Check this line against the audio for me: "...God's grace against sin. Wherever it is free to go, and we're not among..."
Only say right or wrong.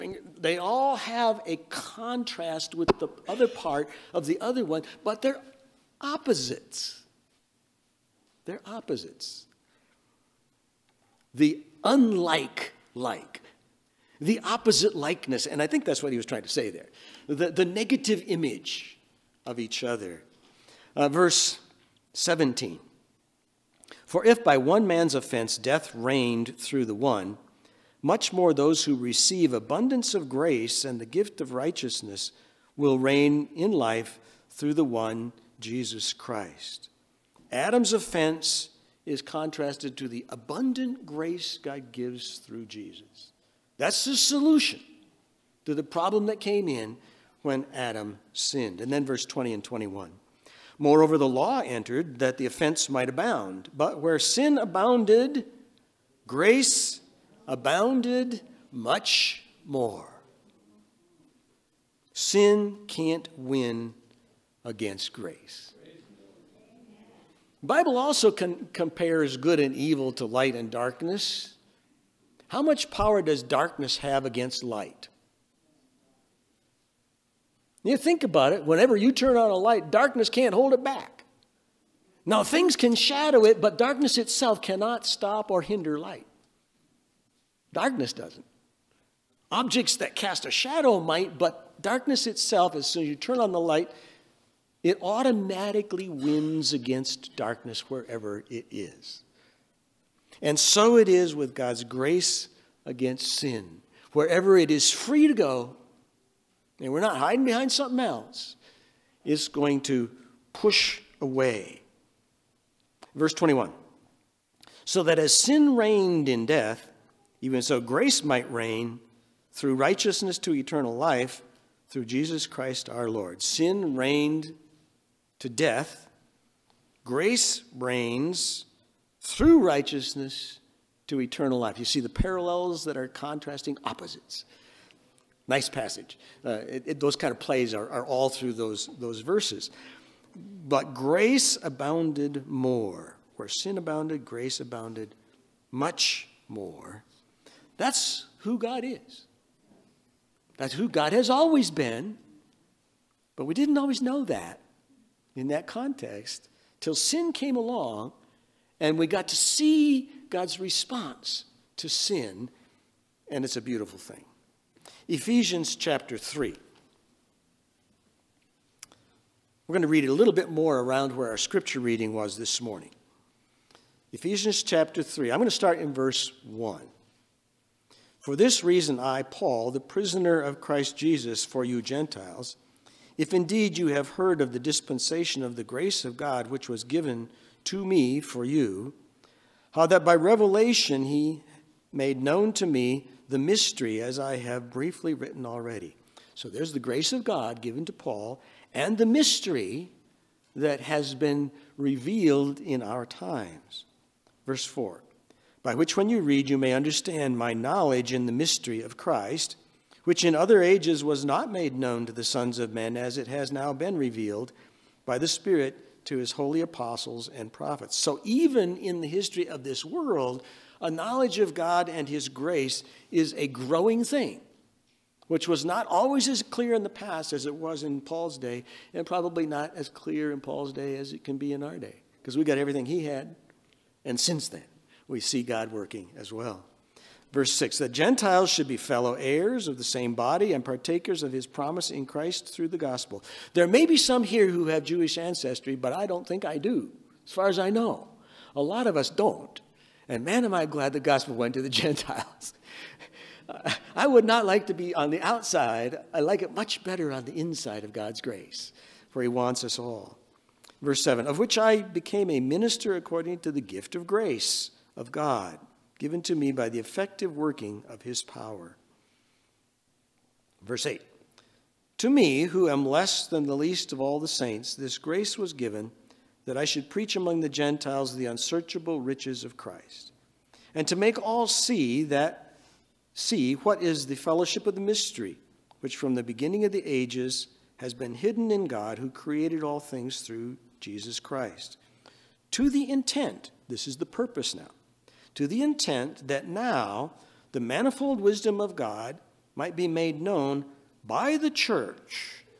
wrong.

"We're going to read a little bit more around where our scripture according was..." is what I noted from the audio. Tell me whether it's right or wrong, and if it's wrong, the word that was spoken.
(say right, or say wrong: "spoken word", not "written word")
wrong: "reading", not "according".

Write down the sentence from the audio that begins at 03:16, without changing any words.
So there's the grace of God given to Paul and the mystery that has been revealed in our times.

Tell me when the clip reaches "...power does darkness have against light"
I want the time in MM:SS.
01:12.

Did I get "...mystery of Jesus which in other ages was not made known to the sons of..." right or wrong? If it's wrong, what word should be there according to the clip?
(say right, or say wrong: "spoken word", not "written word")
wrong: "Christ", not "Jesus".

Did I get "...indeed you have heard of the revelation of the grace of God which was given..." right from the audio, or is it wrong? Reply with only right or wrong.
wrong.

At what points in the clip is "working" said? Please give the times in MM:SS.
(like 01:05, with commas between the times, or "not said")
03:55, 04:27.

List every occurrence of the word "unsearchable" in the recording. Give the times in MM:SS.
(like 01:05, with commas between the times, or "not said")
04:38.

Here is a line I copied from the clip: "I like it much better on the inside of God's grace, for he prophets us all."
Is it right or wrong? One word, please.
wrong.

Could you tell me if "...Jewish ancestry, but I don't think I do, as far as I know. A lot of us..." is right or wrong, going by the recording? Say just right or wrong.
right.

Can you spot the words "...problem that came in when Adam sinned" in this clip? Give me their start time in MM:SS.
00:45.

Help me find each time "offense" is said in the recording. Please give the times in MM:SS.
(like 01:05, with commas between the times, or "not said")
00:25, 00:37, 00:52.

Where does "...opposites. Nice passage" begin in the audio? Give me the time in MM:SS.
02:13.